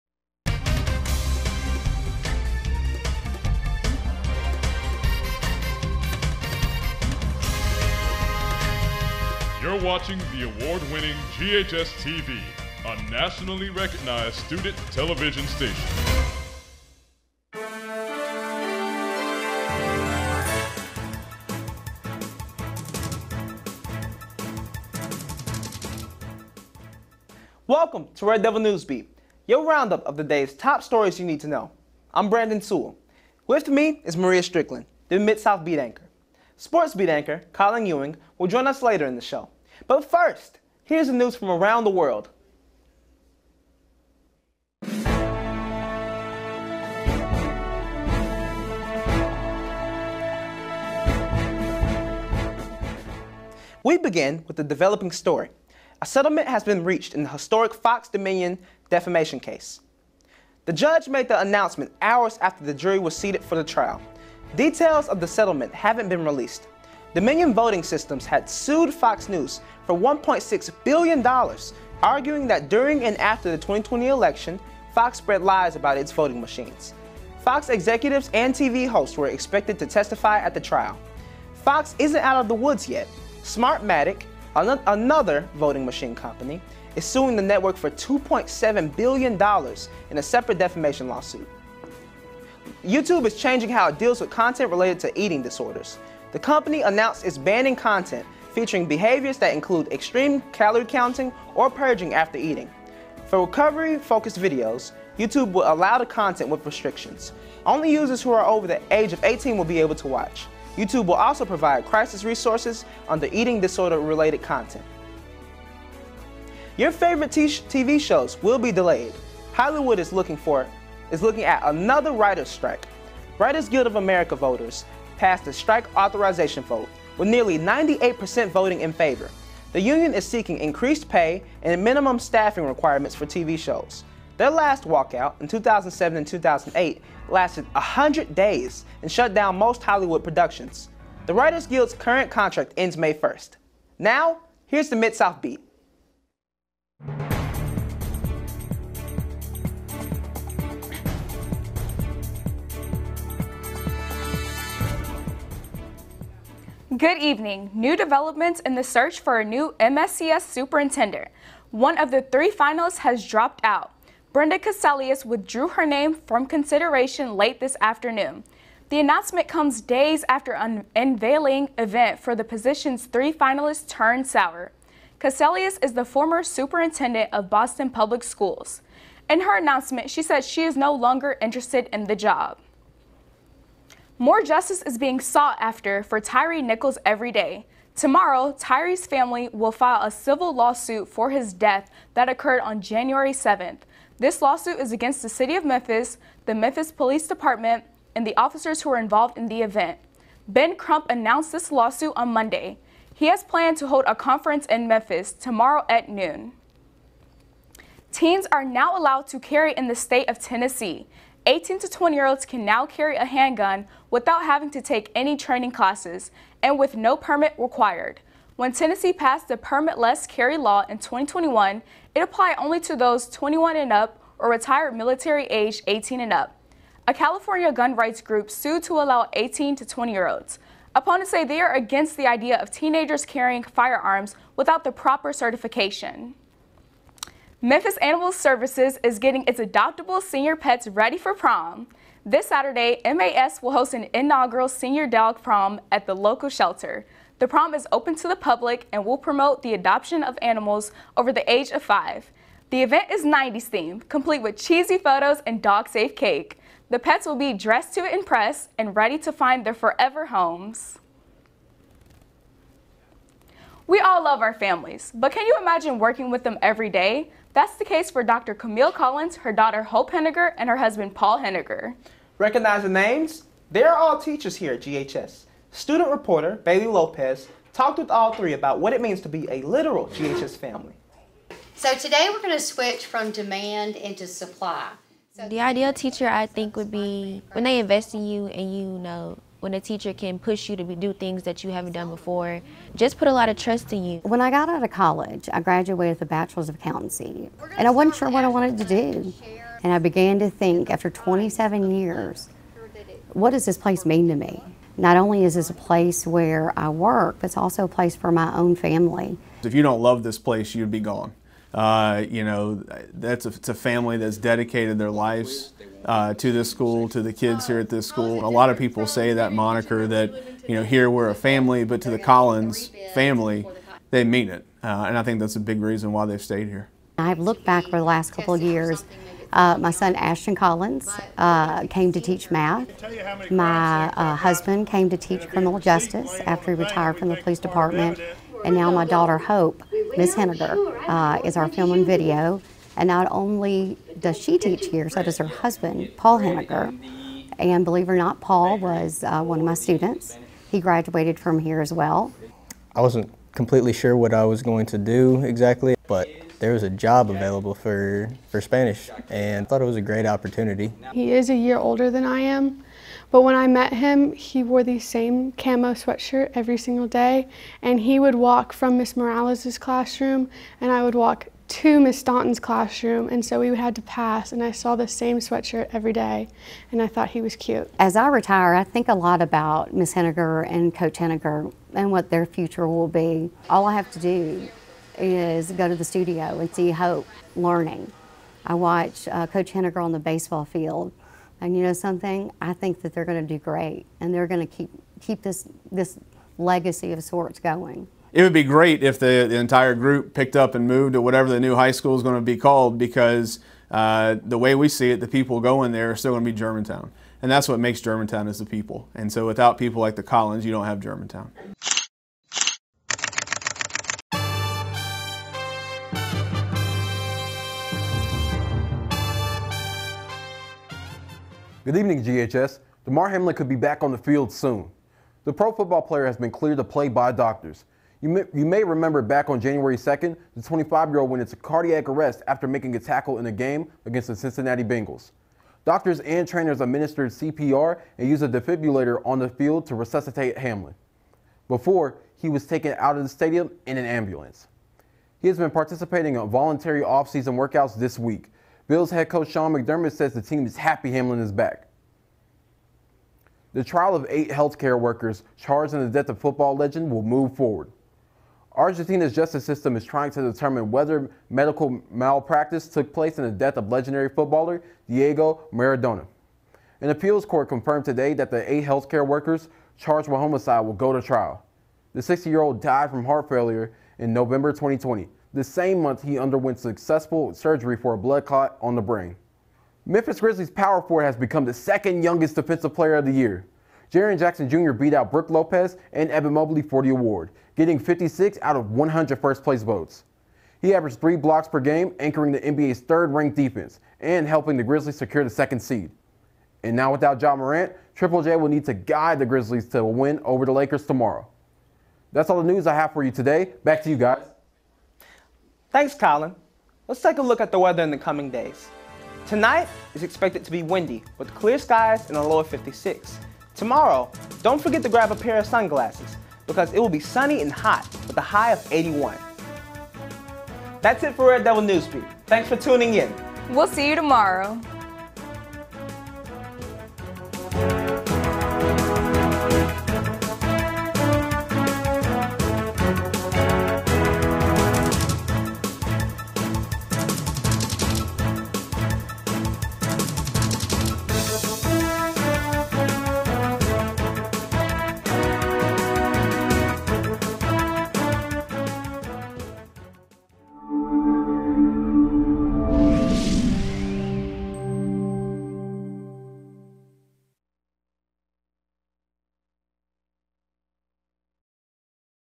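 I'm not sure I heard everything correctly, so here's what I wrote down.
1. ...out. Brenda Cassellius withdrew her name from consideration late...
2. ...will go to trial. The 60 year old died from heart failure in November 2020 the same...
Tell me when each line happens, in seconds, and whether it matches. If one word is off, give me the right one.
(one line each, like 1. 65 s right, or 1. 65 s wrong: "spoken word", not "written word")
1. 163 s right
2. 470 s right.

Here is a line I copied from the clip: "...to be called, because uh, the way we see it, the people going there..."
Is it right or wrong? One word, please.
right.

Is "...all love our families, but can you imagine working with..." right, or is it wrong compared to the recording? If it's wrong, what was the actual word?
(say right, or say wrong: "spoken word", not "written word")
right.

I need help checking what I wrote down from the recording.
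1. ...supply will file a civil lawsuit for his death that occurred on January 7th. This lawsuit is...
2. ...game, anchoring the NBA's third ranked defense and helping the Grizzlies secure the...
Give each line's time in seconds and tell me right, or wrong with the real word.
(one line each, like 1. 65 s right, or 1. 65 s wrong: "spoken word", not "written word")
1. 189 s wrong: "family", not "supply"
2. 491 s right.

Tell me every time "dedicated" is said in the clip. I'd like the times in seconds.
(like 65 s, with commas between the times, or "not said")
314 s.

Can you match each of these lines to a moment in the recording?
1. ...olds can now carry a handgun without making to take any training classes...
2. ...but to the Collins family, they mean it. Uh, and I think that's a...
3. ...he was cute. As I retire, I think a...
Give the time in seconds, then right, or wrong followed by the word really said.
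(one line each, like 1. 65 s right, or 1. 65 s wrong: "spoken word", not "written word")
1. 212 s wrong: "having", not "making"
2. 321 s right
3. 377 s right.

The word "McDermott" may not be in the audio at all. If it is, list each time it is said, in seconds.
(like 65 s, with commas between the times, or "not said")
449 s.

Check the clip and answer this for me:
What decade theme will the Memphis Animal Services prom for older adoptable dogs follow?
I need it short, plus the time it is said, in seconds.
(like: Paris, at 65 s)
90s, at 253 s.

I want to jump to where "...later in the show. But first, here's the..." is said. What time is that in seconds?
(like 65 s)
38 s.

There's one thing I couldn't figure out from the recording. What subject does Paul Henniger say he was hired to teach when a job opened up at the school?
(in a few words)
Spanish.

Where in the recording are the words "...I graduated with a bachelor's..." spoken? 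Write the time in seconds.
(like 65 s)
295 s.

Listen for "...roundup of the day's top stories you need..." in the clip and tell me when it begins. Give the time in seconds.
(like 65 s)
29 s.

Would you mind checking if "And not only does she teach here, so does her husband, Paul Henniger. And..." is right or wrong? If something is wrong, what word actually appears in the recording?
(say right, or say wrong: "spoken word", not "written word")
right.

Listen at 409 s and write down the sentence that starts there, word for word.
And so without people like the Collins, you don't have Germantown.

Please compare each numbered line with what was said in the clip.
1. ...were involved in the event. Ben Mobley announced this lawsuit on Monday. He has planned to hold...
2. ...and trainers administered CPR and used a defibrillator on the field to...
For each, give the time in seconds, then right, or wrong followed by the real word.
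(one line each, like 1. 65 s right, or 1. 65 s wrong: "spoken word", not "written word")
1. 198 s wrong: "Crump", not "Mobley"
2. 436 s right.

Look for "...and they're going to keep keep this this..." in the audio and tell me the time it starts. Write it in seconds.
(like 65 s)
394 s.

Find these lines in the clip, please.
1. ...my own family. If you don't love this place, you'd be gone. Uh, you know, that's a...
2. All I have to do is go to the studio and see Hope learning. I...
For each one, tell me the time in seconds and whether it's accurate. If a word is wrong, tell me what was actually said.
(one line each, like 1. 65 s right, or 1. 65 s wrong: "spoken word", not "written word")
1. 308 s right
2. 383 s right.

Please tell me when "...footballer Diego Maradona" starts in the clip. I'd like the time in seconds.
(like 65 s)
464 s.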